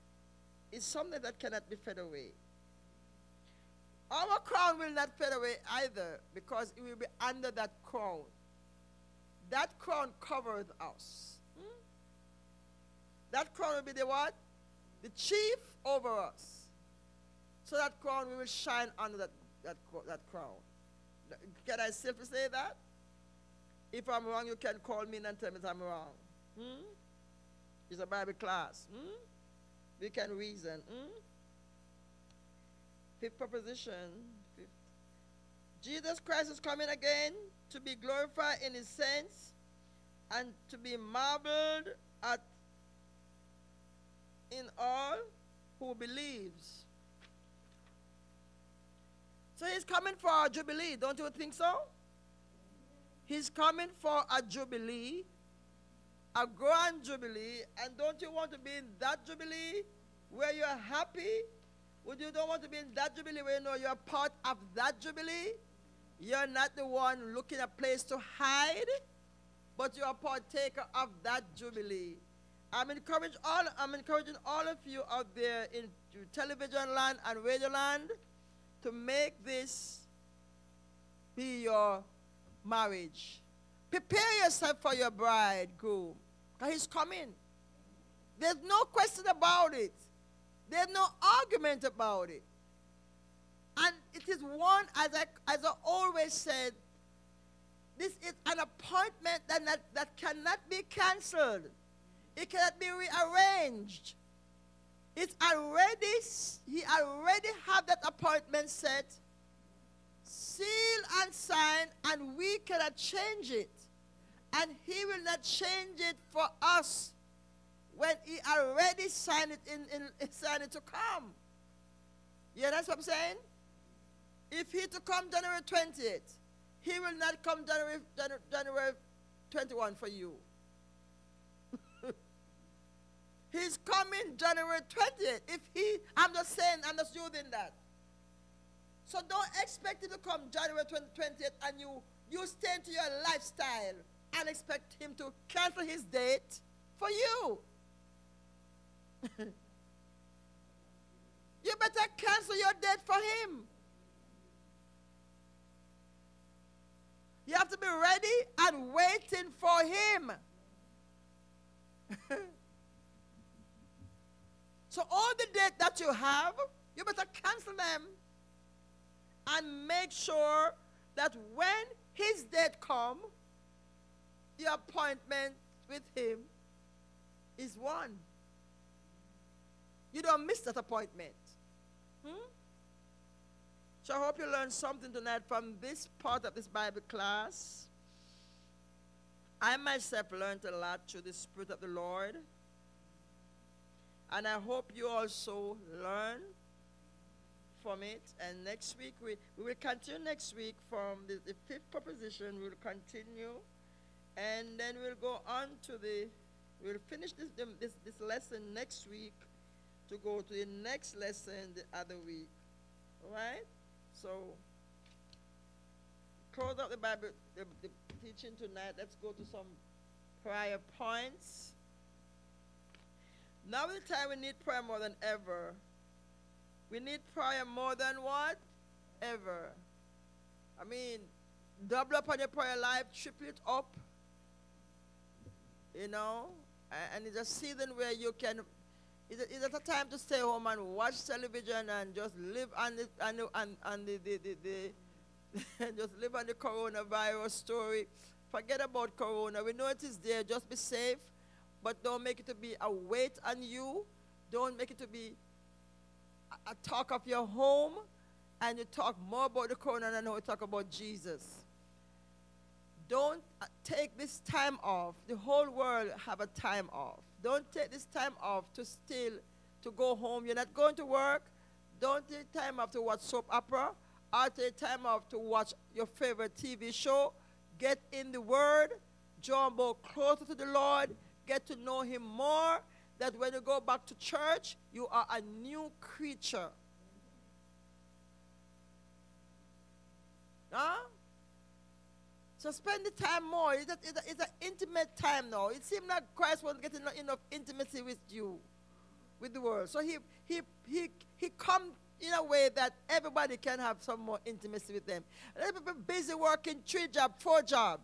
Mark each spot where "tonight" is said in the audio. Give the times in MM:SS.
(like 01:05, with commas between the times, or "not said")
03:05, 03:38.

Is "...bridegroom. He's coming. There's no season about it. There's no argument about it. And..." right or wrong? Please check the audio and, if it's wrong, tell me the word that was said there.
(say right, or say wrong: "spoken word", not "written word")
wrong: "question", not "season".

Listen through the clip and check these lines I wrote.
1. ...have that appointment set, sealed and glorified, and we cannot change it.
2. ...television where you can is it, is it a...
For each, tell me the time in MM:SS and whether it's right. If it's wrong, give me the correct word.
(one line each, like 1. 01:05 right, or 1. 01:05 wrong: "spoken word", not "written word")
1. 01:47 wrong: "signed", not "glorified"
2. 03:57 wrong: "season", not "television".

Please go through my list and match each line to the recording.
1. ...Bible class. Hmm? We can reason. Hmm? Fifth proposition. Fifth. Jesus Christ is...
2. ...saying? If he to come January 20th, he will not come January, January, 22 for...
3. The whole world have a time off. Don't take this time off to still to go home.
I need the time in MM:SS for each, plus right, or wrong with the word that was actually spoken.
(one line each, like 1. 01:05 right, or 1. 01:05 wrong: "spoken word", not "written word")
1. 00:28 right
2. 02:03 wrong: "21", not "22"
3. 04:25 right.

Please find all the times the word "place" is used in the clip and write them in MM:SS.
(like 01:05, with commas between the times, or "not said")
01:07.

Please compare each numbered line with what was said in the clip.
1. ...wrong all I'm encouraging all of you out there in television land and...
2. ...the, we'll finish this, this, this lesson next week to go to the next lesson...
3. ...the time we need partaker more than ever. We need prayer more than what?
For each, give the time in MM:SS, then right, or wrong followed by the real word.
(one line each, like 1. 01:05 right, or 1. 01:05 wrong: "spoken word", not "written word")
1. 01:12 wrong: "encouraging", not "wrong"
2. 03:25 right
3. 03:44 wrong: "prayer", not "partaker".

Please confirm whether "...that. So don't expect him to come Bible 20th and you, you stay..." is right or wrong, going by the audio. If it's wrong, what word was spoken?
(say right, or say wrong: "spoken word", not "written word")
wrong: "January", not "Bible".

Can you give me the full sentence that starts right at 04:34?
Or take time off to watch your favorite TV show.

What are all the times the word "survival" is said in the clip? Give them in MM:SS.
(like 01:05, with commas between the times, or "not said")
not said.